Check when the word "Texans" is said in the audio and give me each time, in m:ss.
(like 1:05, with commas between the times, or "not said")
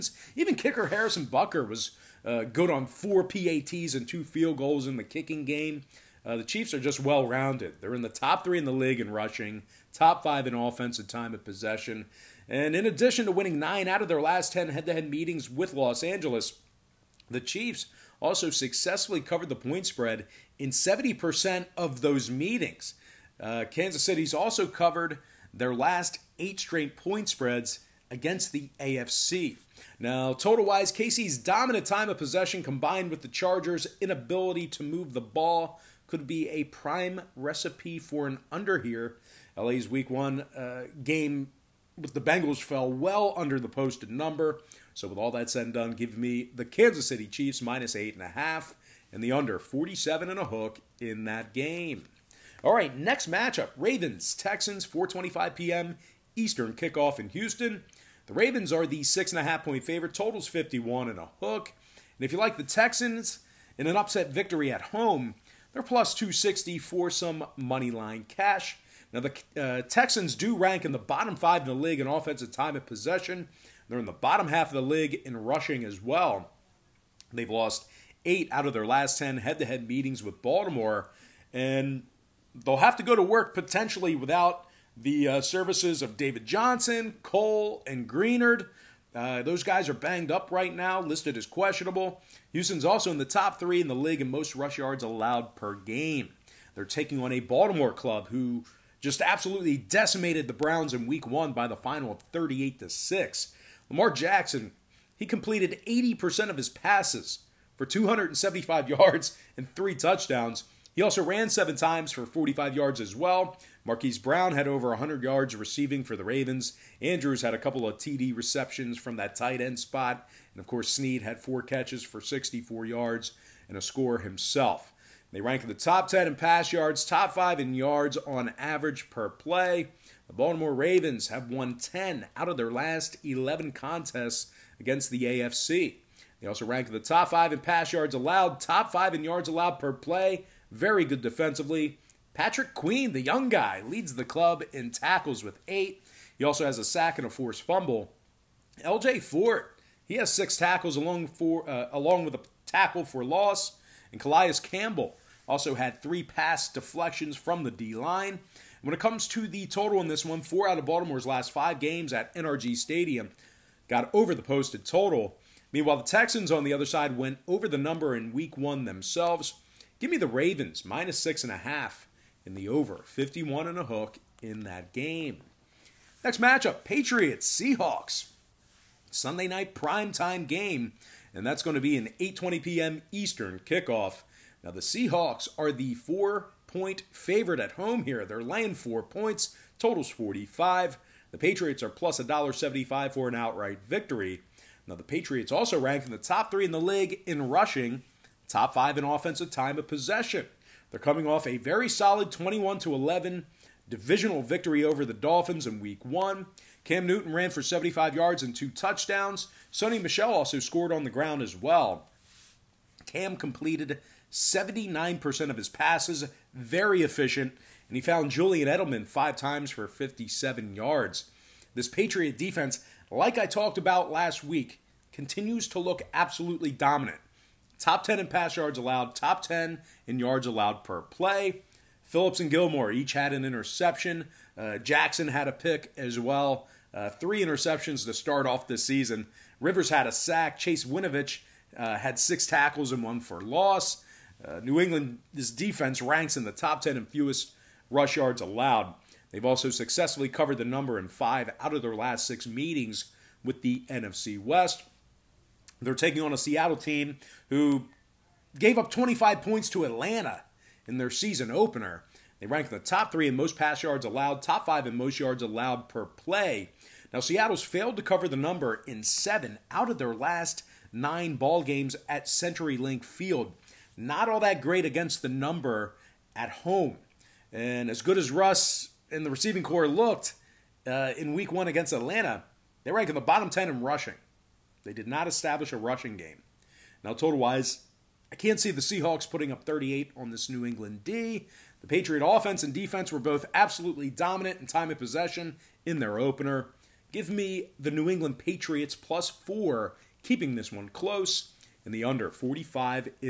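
0:54, 1:02, 1:09, 2:46.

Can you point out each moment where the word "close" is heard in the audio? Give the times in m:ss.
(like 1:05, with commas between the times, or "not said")
5:00.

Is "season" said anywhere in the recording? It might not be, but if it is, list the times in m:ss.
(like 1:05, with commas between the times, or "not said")
3:58, 4:21.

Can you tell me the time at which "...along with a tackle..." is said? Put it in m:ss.
2:31.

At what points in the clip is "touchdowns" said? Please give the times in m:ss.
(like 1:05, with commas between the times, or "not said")
1:49, 3:28.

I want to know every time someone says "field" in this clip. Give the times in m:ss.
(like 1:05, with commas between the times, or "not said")
0:04, 4:33.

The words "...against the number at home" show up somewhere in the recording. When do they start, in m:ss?
4:34.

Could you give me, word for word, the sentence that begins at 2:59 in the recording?
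Sunday night primetime game and that's going to be an 8:20 p.m.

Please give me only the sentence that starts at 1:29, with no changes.
Uh, those guys are banged up right now, listed as questionable.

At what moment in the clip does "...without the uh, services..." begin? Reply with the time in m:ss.
1:24.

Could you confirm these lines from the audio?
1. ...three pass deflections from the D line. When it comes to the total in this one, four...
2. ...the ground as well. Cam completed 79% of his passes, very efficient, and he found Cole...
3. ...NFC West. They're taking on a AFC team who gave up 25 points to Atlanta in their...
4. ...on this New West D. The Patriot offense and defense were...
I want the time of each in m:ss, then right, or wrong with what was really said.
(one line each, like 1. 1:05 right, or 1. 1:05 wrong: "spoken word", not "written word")
1. 2:36 right
2. 3:31 wrong: "Julian", not "Cole"
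3. 4:13 wrong: "Seattle", not "AFC"
4. 4:50 wrong: "England", not "West".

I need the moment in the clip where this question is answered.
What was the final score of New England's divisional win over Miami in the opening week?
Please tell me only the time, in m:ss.
3:22.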